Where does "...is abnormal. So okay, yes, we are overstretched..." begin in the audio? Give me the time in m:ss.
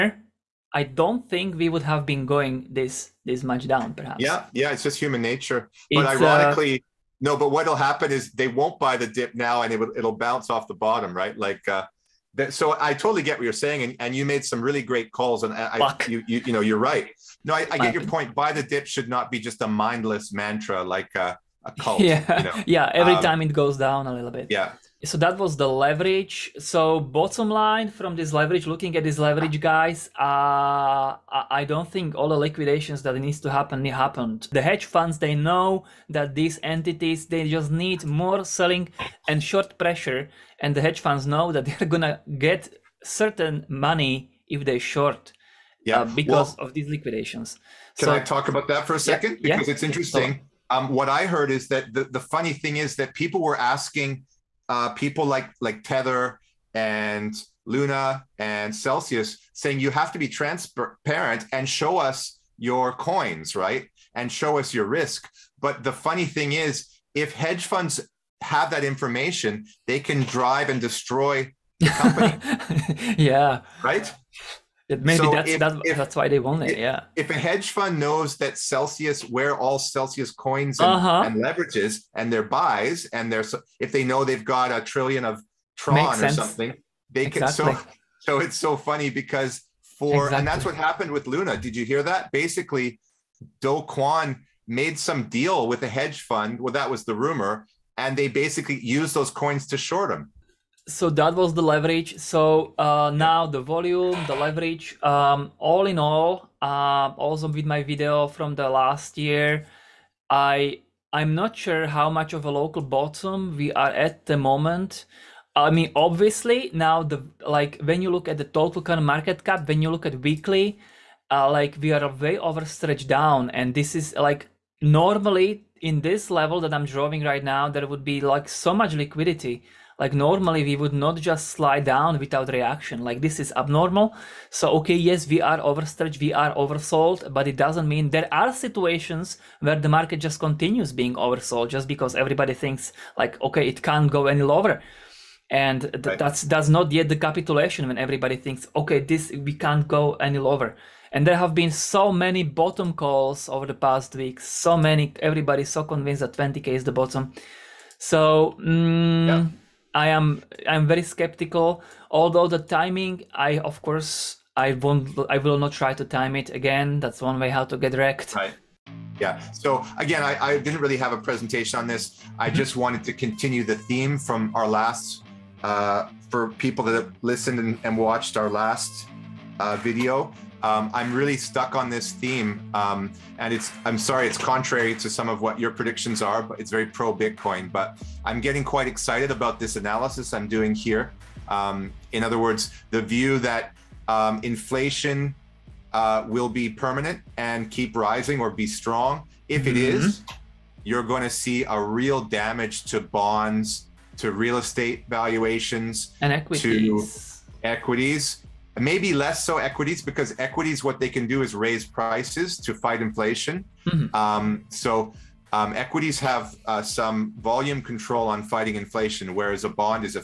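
2:13.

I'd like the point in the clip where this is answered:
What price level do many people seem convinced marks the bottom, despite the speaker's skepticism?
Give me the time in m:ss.
2:36.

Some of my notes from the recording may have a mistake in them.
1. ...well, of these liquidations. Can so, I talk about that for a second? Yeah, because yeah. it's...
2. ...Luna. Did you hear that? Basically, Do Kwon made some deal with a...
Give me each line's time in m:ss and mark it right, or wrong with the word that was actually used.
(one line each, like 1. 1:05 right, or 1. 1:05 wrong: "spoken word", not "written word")
1. 0:46 right
2. 1:31 right.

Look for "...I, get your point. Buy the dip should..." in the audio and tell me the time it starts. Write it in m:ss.
0:17.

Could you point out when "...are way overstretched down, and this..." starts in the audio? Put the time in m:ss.
2:01.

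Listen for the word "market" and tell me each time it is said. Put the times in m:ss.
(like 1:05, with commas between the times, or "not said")
1:59, 2:19.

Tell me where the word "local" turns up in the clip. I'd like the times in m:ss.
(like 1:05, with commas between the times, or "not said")
1:52.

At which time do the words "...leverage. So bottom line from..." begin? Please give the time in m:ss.
0:25.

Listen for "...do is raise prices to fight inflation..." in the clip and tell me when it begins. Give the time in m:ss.
3:31.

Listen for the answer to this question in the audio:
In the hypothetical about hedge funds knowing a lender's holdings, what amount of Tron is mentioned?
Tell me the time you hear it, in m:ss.
1:24.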